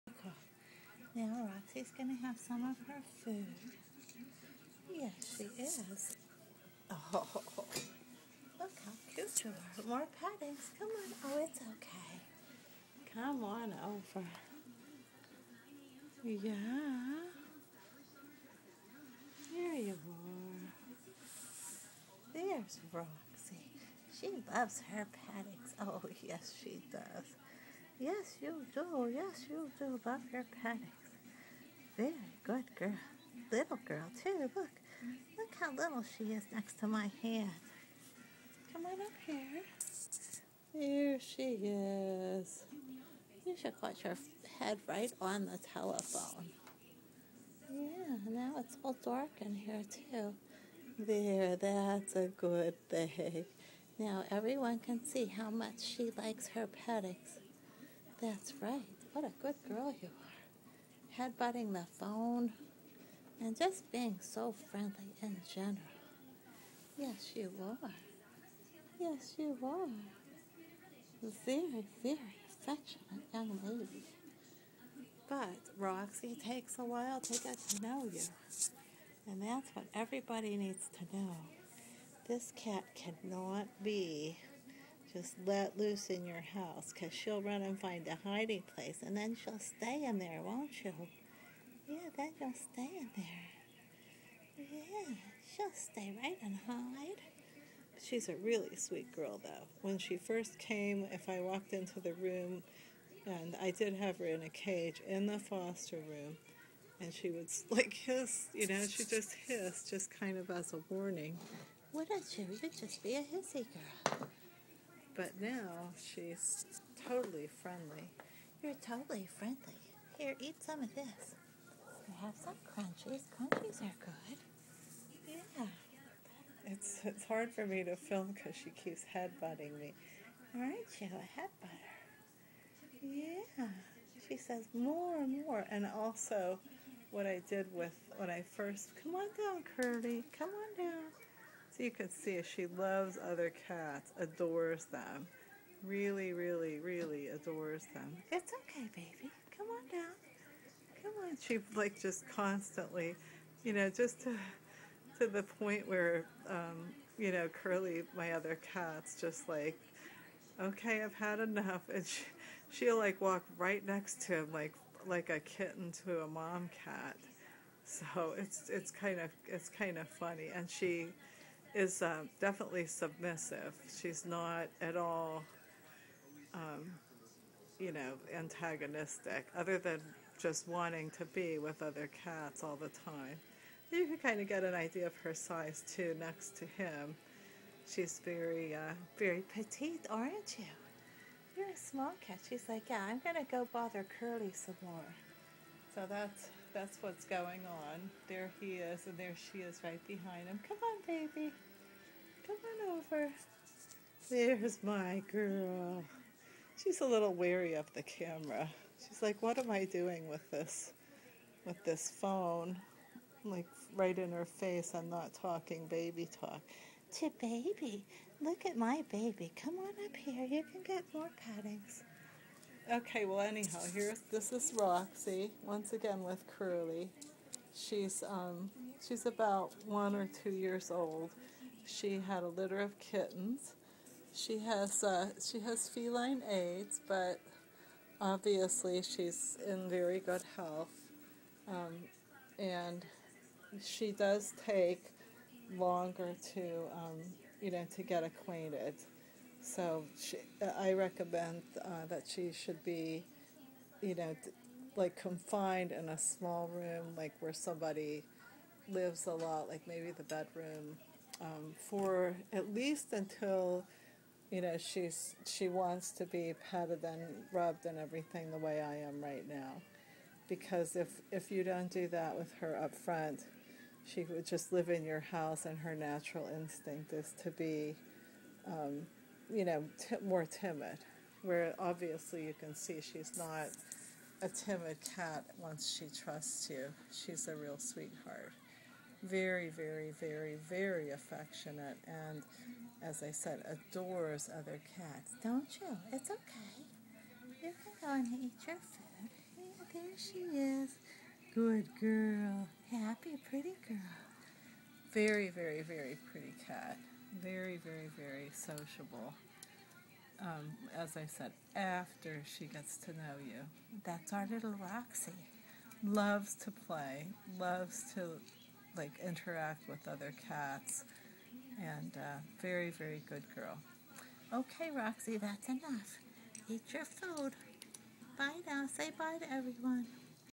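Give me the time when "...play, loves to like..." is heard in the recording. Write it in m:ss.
5:16.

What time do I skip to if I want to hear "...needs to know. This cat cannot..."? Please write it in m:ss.
1:20.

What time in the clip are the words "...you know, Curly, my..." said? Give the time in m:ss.
2:37.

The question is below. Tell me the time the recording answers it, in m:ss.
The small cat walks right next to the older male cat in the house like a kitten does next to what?
2:46.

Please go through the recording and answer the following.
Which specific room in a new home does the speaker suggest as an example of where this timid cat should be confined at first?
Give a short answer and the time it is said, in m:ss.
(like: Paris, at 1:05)
bedroom, at 4:20.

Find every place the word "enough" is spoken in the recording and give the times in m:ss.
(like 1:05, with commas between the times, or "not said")
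2:41, 5:25.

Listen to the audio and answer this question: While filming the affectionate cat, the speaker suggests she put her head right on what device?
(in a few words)
telephone.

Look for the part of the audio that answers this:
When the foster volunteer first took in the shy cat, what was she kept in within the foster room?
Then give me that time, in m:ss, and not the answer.
1:44.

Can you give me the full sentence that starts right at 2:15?
And also, what I did with when I first, come on down, Curly.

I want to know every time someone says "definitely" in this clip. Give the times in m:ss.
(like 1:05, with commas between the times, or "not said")
2:52.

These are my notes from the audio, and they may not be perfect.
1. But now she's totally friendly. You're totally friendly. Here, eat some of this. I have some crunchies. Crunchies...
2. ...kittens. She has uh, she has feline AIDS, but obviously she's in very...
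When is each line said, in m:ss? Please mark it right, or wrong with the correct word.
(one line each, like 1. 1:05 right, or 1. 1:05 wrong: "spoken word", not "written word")
1. 1:55 right
2. 3:52 right.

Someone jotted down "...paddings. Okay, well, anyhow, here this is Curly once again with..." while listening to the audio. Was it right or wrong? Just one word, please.
wrong.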